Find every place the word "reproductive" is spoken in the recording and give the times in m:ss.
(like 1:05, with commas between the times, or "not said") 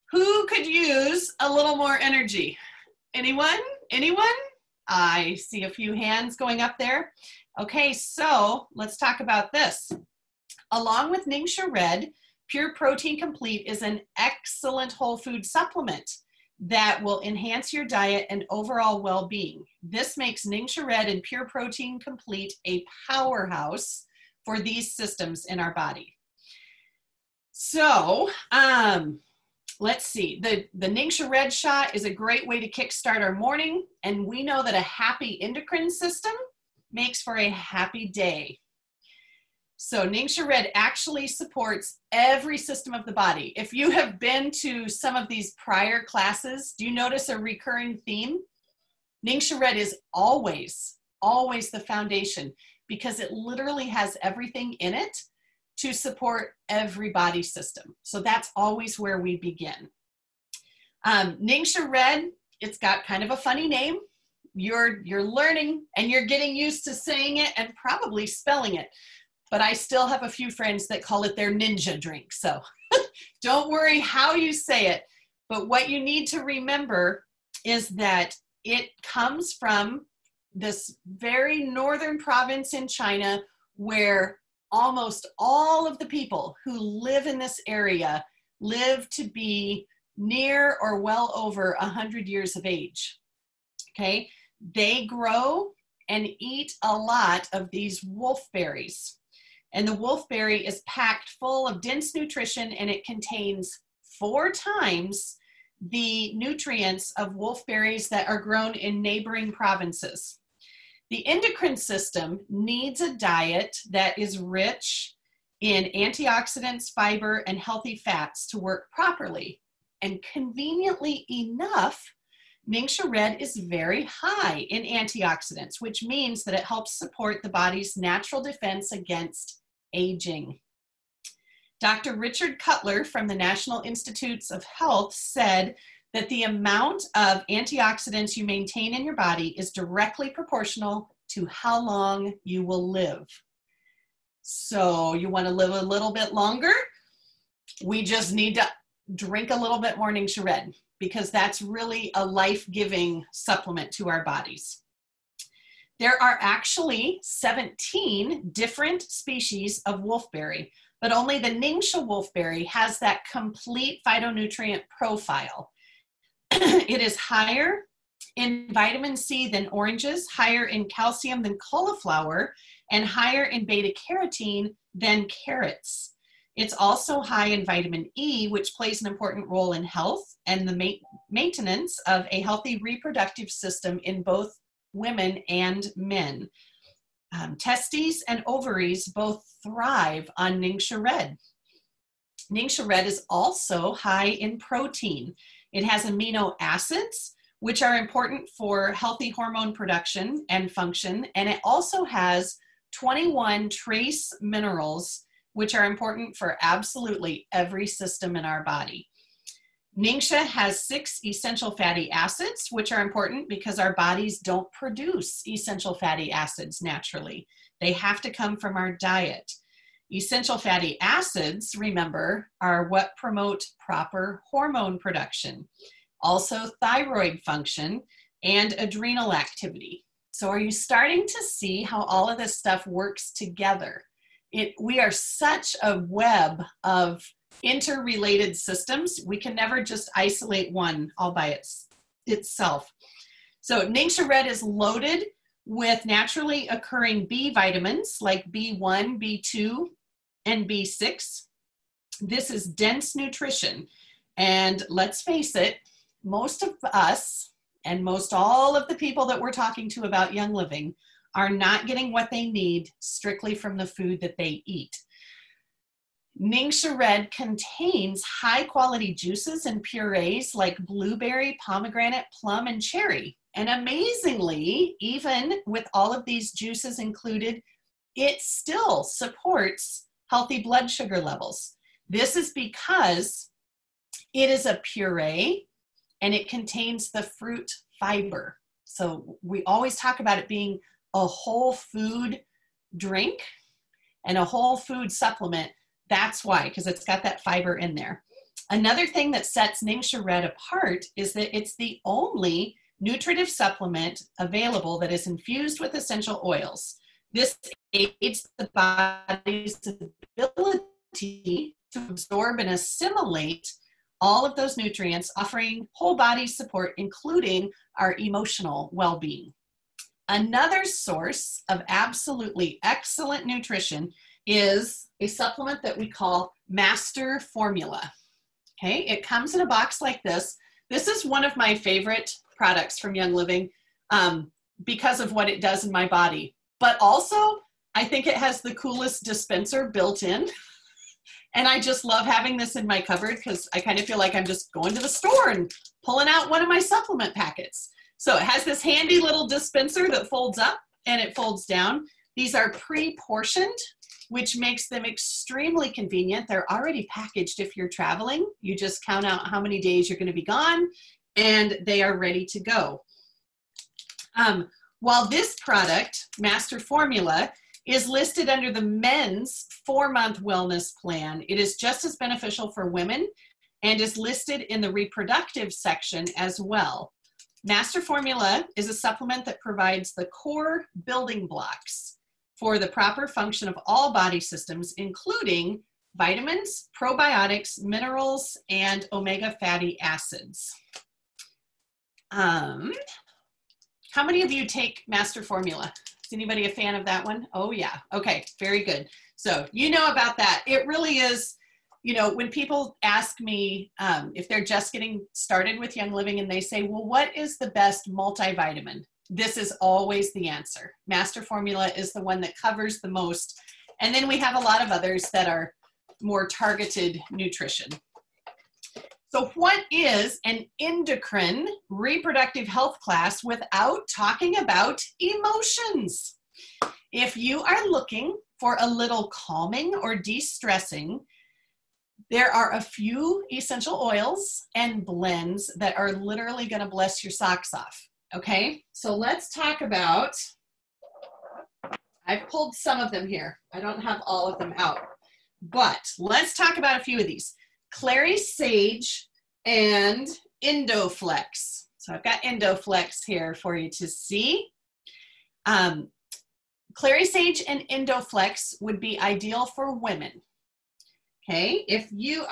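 3:02, 6:14, 7:01.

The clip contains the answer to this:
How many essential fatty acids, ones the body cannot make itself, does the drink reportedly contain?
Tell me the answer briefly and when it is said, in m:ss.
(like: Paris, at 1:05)
6, at 3:30.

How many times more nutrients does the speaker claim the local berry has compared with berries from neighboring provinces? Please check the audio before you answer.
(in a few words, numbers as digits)
4.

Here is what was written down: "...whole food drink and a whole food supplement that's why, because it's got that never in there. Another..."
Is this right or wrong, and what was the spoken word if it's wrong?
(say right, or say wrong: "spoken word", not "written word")
wrong: "fiber", not "never".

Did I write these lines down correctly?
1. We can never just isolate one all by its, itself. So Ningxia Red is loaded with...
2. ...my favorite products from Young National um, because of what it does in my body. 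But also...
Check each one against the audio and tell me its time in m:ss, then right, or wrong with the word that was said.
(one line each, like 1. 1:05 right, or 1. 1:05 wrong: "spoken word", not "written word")
1. 3:59 right
2. 5:31 wrong: "Living", not "National".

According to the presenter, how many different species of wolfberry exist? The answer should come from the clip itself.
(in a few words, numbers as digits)
17.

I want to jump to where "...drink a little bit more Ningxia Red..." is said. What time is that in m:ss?
2:29.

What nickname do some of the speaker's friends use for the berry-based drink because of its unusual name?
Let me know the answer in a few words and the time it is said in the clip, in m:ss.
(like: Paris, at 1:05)
ninja drink, at 1:11.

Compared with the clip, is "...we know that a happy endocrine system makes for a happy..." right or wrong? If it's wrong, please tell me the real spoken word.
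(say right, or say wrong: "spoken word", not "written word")
right.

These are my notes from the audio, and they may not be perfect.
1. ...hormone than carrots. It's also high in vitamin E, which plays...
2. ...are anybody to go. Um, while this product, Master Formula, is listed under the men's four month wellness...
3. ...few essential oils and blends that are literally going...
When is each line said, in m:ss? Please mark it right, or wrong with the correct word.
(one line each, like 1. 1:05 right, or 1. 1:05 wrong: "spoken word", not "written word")
1. 2:54 wrong: "carotene", not "hormone"
2. 6:02 wrong: "ready", not "anybody"
3. 7:12 right.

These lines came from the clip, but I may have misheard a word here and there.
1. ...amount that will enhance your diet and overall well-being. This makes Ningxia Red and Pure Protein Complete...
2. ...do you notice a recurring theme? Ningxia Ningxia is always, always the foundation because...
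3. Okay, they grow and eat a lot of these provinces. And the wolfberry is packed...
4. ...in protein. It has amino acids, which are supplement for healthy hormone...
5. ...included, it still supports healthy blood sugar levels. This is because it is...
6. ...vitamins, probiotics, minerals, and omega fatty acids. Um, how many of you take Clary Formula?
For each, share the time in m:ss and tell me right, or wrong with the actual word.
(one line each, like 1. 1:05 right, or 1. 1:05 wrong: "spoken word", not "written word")
1. 0:15 wrong: "supplement", not "amount"
2. 0:46 wrong: "Red", not "Ningxia"
3. 1:33 wrong: "wolfberries", not "provinces"
4. 3:14 wrong: "important", not "supplement"
5. 4:36 right
6. 6:26 wrong: "Master", not "Clary".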